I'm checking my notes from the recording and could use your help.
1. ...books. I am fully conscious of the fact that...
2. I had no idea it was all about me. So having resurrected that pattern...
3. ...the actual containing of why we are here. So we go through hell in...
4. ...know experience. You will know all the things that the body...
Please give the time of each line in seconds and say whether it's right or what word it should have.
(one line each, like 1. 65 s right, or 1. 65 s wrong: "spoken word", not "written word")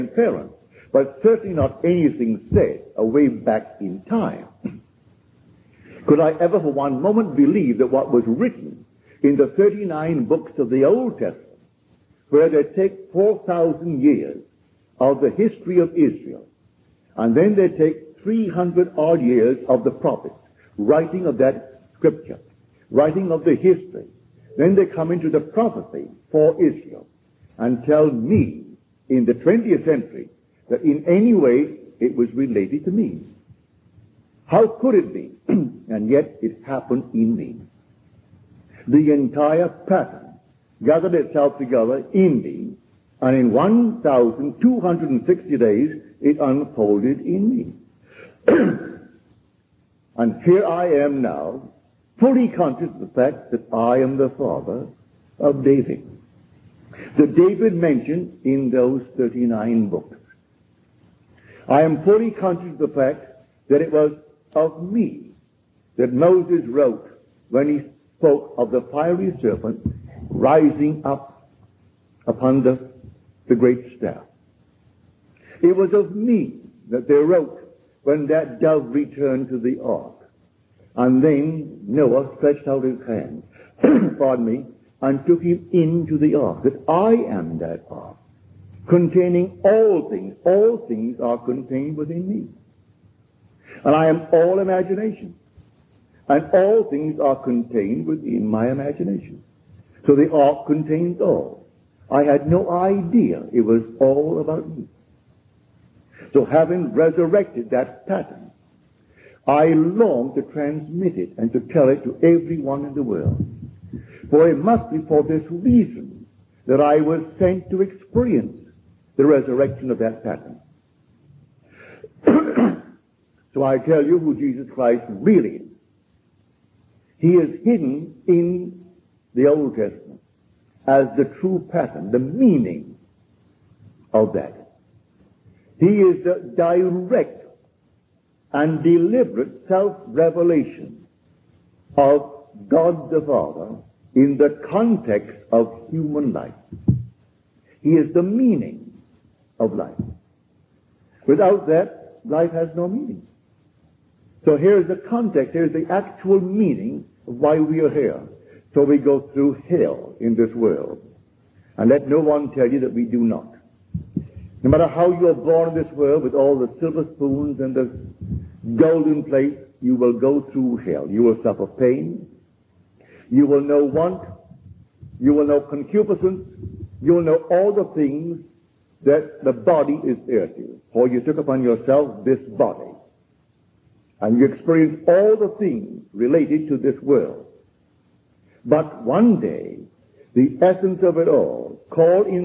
1. 59 s right
2. 102 s right
3. 155 s wrong: "meaning", not "containing"
4. 175 s wrong: "concupiscence", not "experience".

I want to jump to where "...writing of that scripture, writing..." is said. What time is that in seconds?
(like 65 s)
20 s.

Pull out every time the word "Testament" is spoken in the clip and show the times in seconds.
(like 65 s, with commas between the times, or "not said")
11 s, 129 s.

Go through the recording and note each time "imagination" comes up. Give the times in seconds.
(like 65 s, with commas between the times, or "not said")
94 s, 98 s.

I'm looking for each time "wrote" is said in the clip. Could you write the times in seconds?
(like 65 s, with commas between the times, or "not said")
66 s, 77 s.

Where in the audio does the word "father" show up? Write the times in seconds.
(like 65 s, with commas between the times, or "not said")
54 s, 143 s.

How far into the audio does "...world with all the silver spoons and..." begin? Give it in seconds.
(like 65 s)
165 s.